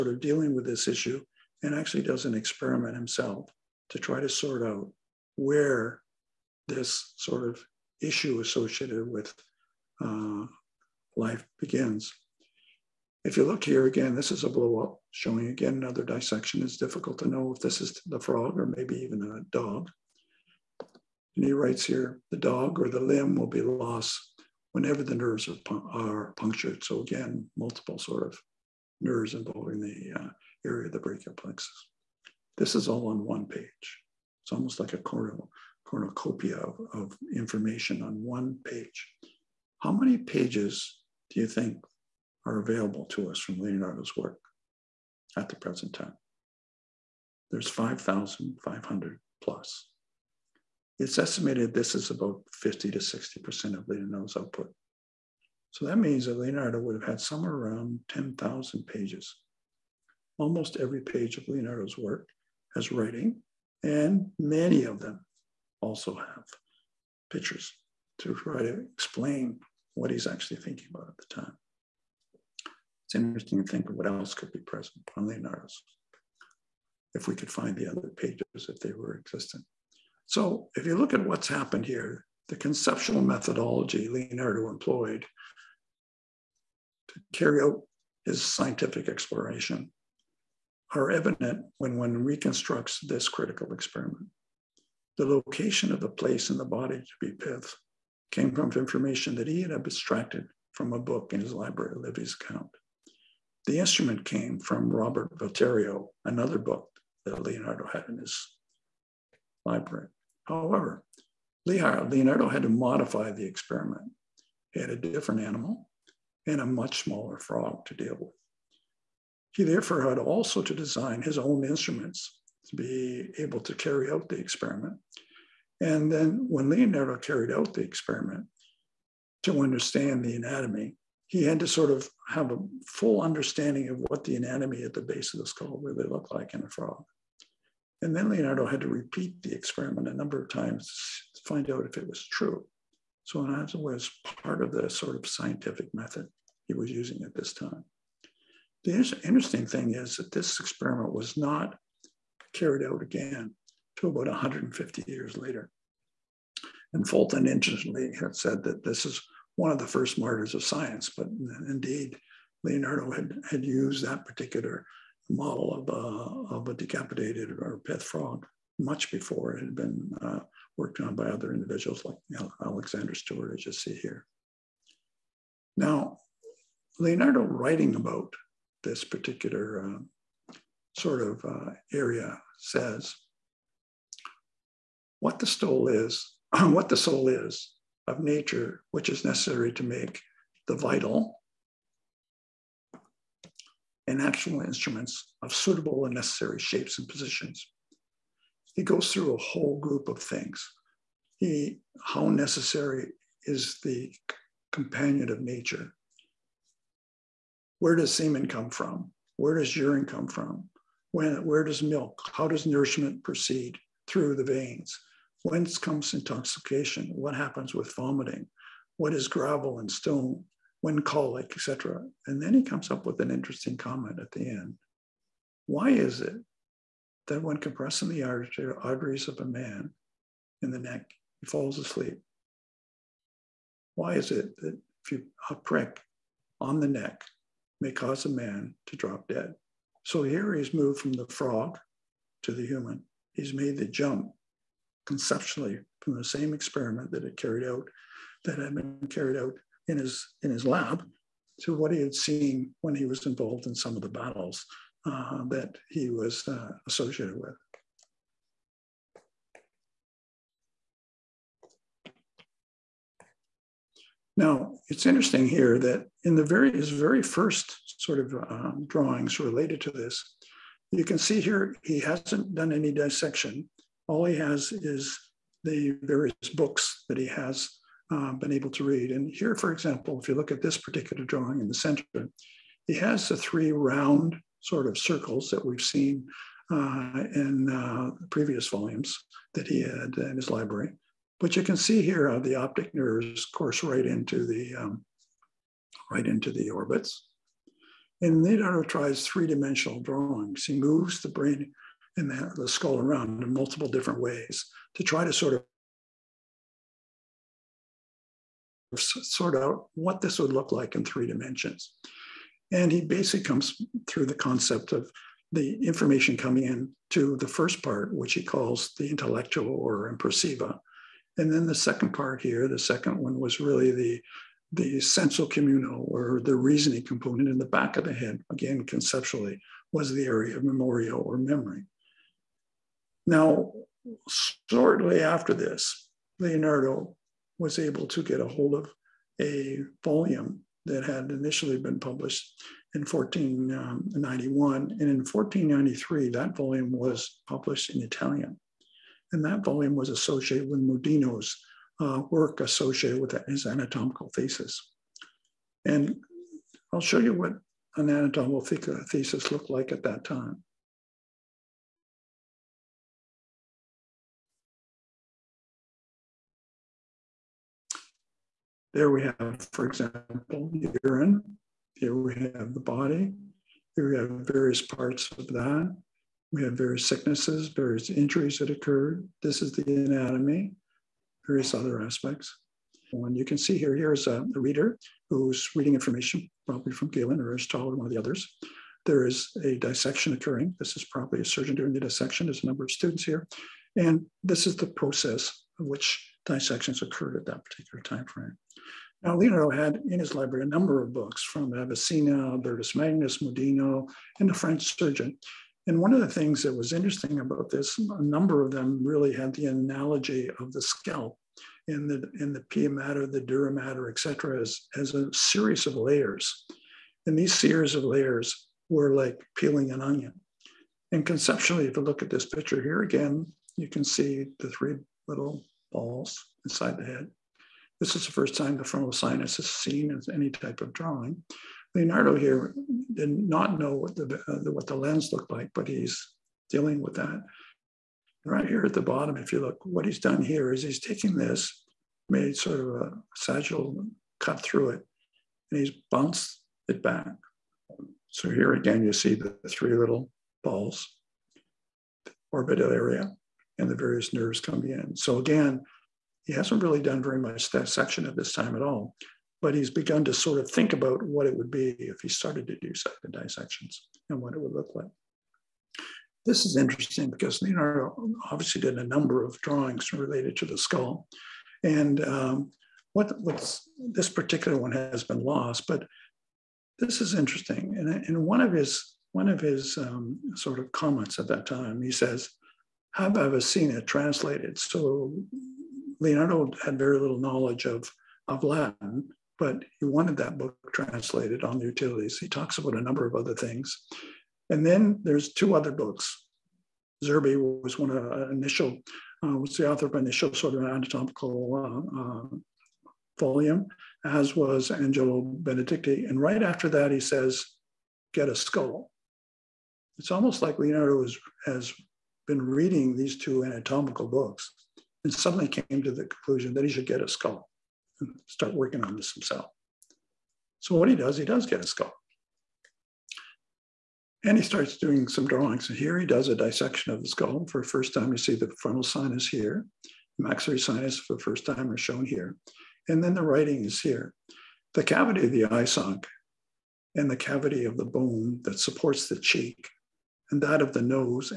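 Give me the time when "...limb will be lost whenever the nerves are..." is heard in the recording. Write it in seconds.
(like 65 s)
23 s.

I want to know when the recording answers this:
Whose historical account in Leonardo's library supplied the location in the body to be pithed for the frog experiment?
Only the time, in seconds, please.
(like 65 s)
101 s.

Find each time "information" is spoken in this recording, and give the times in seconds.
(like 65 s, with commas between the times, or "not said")
37 s, 98 s, 315 s, 385 s.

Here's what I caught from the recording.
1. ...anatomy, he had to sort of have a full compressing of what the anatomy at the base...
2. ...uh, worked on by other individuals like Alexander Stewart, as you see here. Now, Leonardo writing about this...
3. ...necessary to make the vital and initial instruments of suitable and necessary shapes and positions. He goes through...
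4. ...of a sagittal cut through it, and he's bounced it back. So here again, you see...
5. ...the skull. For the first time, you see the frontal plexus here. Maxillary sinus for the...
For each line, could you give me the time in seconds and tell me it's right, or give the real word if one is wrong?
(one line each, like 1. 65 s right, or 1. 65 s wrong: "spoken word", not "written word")
1. 130 s wrong: "understanding", not "compressing"
2. 170 s right
3. 189 s wrong: "actual", not "initial"
4. 442 s right
5. 527 s wrong: "sinus", not "plexus".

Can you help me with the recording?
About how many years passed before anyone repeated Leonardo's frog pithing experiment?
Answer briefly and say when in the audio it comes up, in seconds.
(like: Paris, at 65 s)
150 years, at 154 s.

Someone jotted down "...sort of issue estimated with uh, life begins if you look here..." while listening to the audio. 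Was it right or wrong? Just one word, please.
wrong.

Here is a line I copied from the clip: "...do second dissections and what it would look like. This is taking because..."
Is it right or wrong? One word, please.
wrong.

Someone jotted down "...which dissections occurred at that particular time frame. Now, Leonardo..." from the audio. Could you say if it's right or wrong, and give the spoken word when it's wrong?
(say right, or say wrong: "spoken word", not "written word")
right.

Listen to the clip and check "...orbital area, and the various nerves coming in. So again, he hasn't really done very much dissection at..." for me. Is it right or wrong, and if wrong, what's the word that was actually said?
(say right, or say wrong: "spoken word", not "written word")
right.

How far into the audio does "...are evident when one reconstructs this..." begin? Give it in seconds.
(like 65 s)
90 s.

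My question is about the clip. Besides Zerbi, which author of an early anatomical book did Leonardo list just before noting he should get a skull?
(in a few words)
Angelo Benedicti.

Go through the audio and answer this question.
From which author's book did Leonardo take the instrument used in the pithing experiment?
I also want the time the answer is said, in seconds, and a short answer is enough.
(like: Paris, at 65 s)
Robert Valturio, at 104 s.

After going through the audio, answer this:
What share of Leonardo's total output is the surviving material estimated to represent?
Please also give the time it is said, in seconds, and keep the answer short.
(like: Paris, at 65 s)
50 to 60%, at 52 s.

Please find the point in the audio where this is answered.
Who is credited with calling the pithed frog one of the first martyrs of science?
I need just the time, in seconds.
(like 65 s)
157 s.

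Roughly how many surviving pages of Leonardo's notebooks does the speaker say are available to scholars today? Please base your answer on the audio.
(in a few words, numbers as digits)
5,500.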